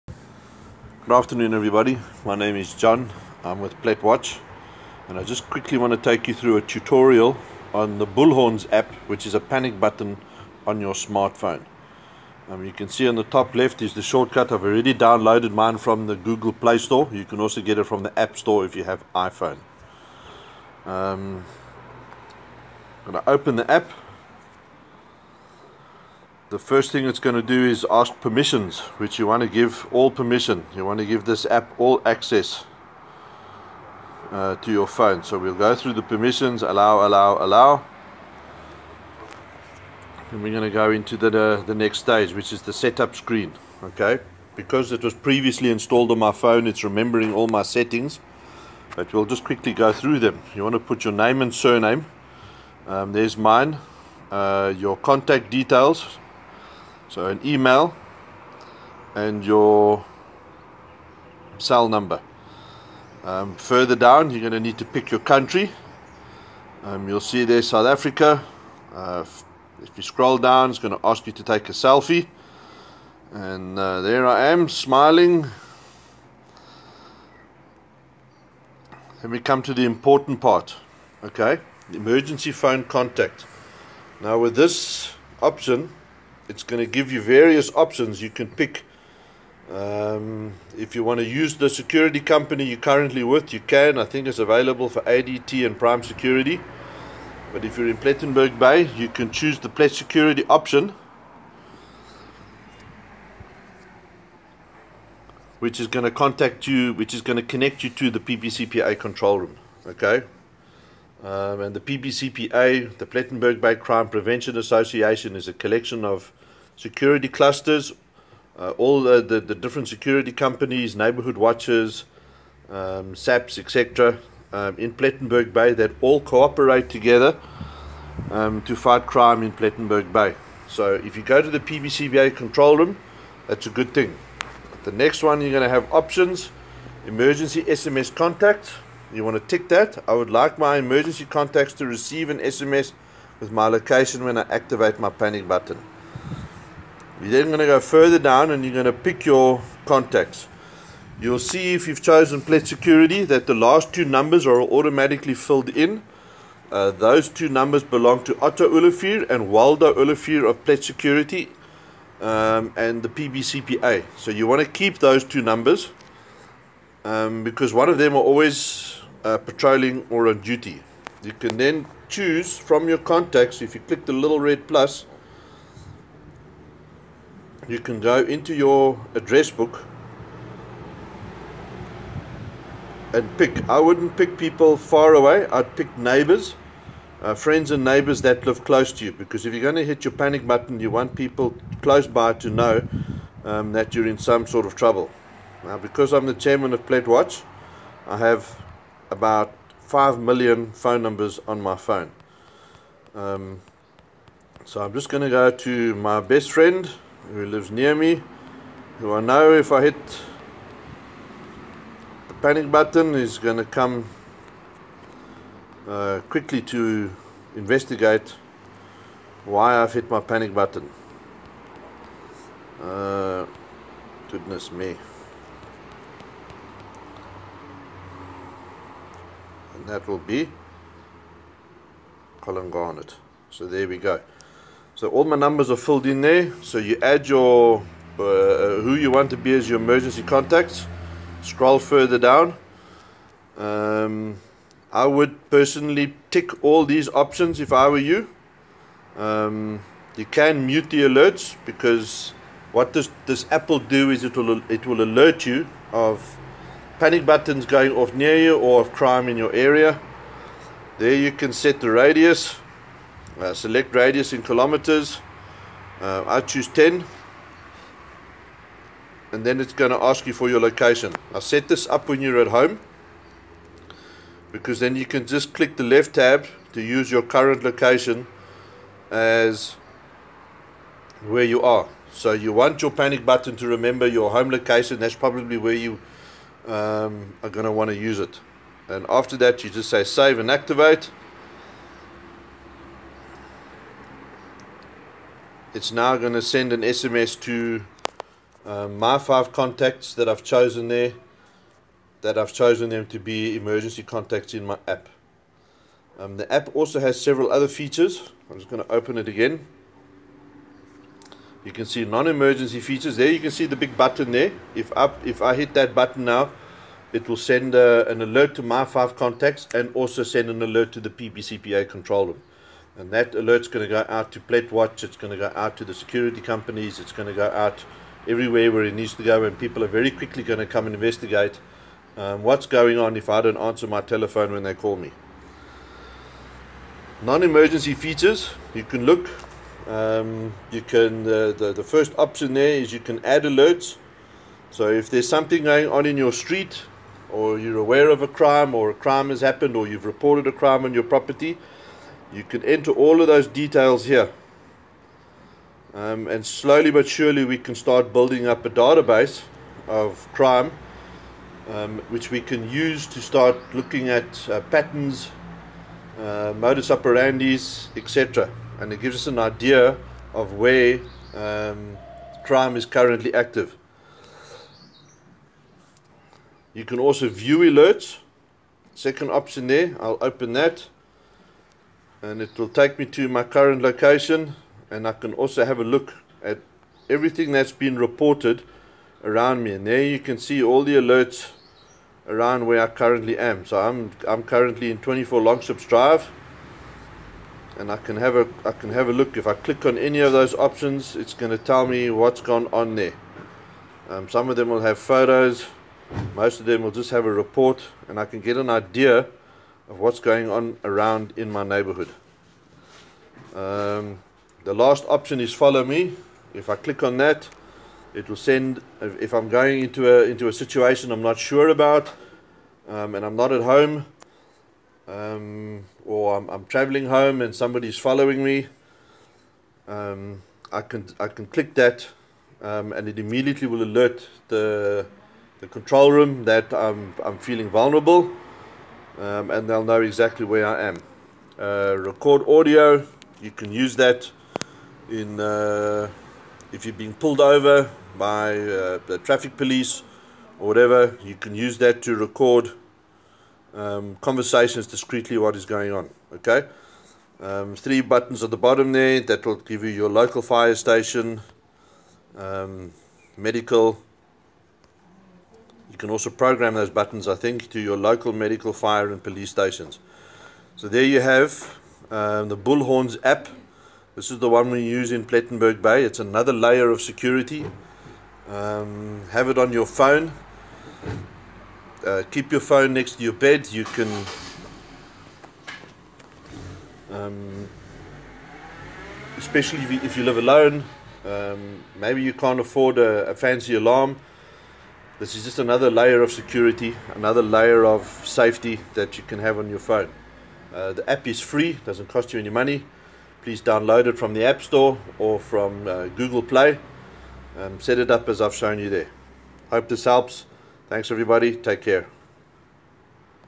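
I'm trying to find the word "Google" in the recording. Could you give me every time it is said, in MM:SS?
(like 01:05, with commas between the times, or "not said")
00:16, 08:26.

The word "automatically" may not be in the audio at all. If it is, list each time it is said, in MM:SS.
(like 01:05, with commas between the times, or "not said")
02:34.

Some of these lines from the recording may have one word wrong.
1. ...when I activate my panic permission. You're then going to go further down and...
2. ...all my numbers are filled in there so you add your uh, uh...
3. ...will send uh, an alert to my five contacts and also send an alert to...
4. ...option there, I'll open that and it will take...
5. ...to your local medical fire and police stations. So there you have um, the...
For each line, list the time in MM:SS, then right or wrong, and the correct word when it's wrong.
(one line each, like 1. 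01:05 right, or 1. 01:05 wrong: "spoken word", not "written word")
1. 02:24 wrong: "button", not "permission"
2. 03:55 right
3. 05:17 right
4. 06:19 right
5. 07:47 right.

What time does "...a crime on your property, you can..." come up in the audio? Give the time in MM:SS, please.
05:50.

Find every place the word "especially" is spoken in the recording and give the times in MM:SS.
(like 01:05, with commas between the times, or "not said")
08:09.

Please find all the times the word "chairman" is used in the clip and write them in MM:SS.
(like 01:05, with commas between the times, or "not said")
03:16.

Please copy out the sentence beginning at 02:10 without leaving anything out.
So if you go to the PBCPA control room, that's a good thing.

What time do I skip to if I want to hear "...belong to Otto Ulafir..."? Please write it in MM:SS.
02:37.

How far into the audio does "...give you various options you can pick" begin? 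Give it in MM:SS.
01:26.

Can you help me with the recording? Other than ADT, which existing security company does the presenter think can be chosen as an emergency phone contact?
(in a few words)
Prime Security.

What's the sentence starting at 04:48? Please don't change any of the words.
And after that, you just say save and activate.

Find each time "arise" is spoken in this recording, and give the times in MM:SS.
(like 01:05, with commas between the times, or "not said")
not said.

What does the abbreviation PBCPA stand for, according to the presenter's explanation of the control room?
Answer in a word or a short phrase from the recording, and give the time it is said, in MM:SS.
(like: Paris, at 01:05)
Plettenberg Bay Crime Prevention Association, at 01:53.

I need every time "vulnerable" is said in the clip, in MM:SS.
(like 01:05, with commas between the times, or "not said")
07:17.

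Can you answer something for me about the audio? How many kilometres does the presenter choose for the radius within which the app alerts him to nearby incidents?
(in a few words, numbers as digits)
10.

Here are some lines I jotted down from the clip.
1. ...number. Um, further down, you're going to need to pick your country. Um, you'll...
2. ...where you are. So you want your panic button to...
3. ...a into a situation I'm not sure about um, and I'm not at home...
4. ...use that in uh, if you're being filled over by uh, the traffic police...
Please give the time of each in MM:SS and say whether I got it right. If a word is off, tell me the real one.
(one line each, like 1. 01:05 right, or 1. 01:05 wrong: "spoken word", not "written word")
1. 01:01 right
2. 04:41 right
3. 07:00 right
4. 07:23 wrong: "pulled", not "filled".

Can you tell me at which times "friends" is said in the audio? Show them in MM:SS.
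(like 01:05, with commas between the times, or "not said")
03:07, 03:26.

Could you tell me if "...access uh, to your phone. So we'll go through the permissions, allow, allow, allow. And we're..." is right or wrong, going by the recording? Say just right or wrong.
right.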